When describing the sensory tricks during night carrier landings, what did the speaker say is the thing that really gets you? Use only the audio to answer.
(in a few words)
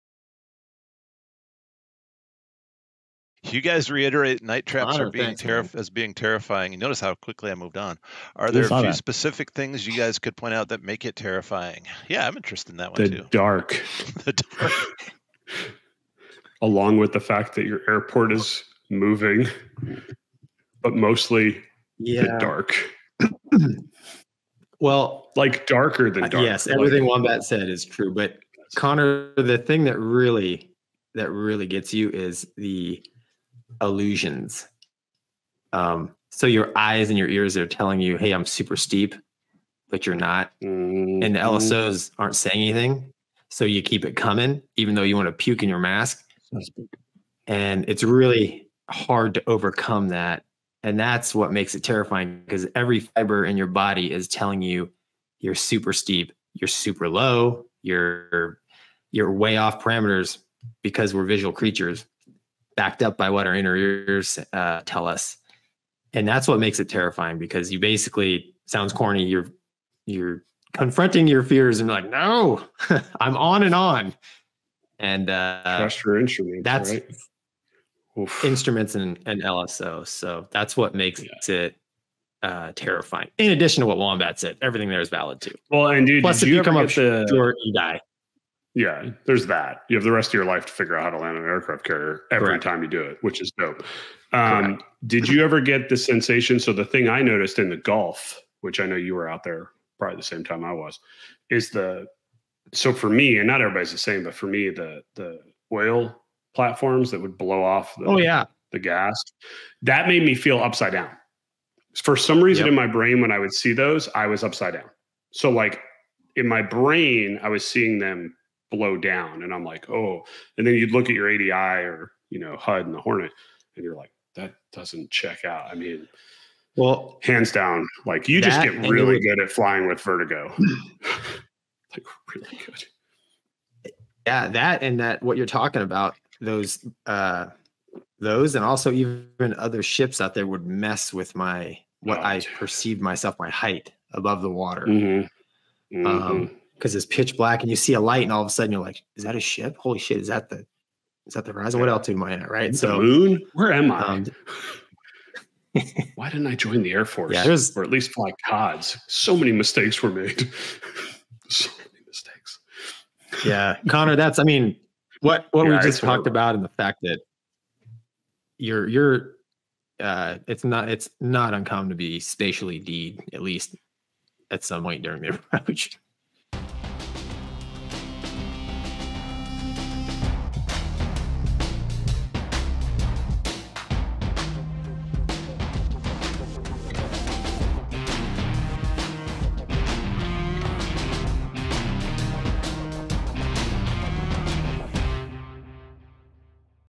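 illusions.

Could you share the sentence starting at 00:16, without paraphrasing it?
Along with the fact that your airport is moving, but mostly yeah.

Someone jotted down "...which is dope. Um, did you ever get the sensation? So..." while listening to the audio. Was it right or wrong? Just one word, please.
right.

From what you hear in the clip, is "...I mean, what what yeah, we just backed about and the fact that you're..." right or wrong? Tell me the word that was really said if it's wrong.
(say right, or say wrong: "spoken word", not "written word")
wrong: "talked", not "backed".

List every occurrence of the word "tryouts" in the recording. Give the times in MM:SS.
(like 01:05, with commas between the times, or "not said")
not said.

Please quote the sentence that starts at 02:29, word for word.
Holy shit, is that the is that the horizon?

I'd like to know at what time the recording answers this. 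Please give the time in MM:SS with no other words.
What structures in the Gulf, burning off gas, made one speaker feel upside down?
01:45.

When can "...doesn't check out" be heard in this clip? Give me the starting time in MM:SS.
02:04.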